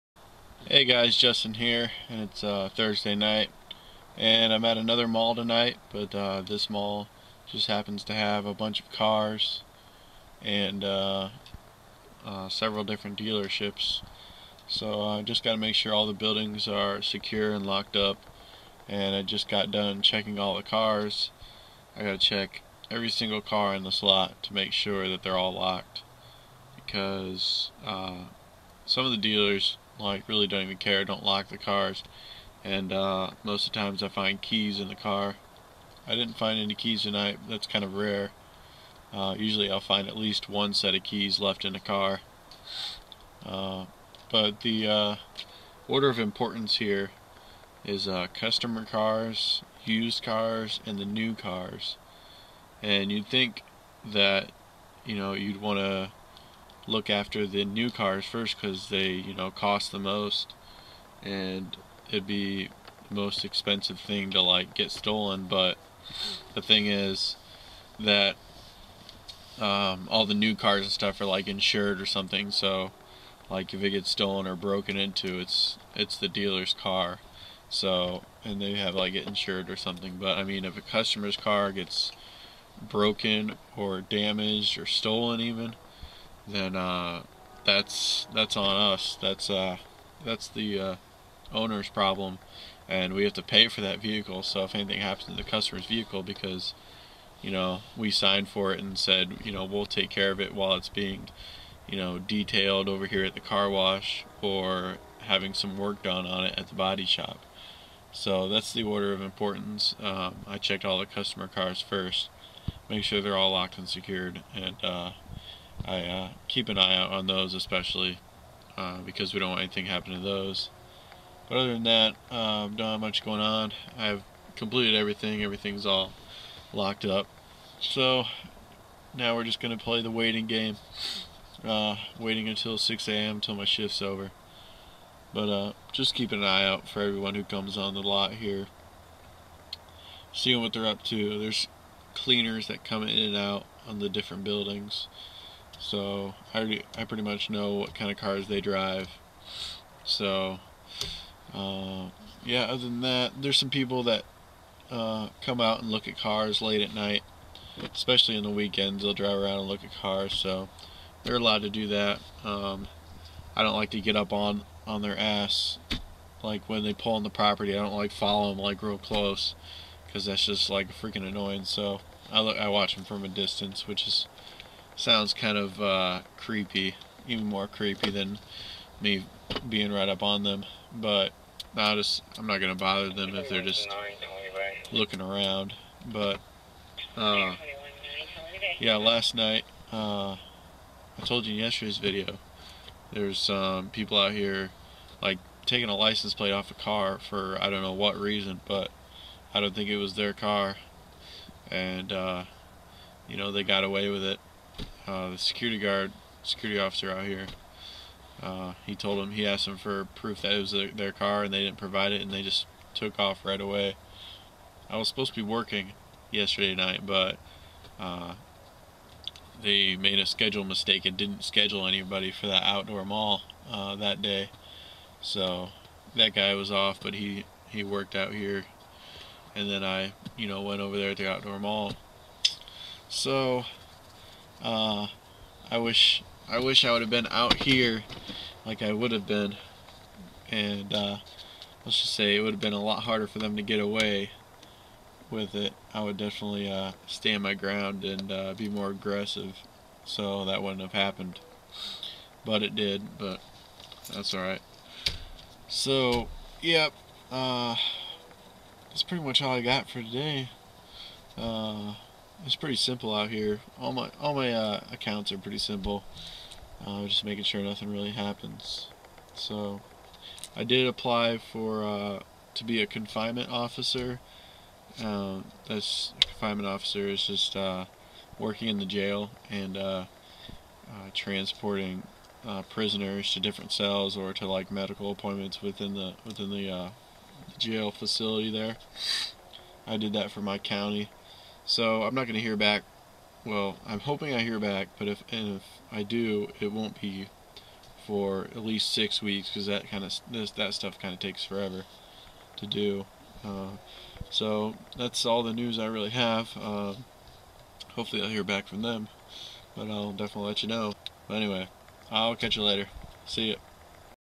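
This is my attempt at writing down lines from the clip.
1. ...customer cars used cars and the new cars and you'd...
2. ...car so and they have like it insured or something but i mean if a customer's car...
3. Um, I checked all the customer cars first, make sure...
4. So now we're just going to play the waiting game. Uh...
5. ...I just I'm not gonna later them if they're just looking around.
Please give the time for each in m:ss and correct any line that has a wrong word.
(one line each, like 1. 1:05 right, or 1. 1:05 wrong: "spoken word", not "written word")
1. 0:48 right
2. 1:16 right
3. 1:50 right
4. 2:07 right
5. 3:01 wrong: "bother", not "later".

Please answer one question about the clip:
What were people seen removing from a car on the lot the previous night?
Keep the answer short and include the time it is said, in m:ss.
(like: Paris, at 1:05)
A license plate, at 3:15.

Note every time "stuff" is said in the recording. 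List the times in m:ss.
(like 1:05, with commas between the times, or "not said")
1:10, 5:00.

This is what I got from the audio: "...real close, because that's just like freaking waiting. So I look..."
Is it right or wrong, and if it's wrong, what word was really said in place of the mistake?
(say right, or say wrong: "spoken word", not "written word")
wrong: "annoying", not "waiting".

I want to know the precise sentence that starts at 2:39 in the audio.
They'll drive around and look at cars, so they're allowed to do that.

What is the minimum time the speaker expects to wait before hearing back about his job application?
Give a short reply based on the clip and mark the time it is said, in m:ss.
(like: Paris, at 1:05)
6 weeks, at 4:58.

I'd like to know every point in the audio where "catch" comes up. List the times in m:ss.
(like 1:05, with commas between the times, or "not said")
5:12.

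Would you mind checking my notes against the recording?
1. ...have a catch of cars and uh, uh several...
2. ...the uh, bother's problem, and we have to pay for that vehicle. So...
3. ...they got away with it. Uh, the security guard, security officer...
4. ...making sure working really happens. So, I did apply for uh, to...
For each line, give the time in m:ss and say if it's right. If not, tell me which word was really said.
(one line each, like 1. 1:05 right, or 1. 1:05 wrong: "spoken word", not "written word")
1. 0:08 wrong: "bunch", not "catch"
2. 1:30 wrong: "owner", not "bother"
3. 3:23 right
4. 4:27 wrong: "nothing", not "working".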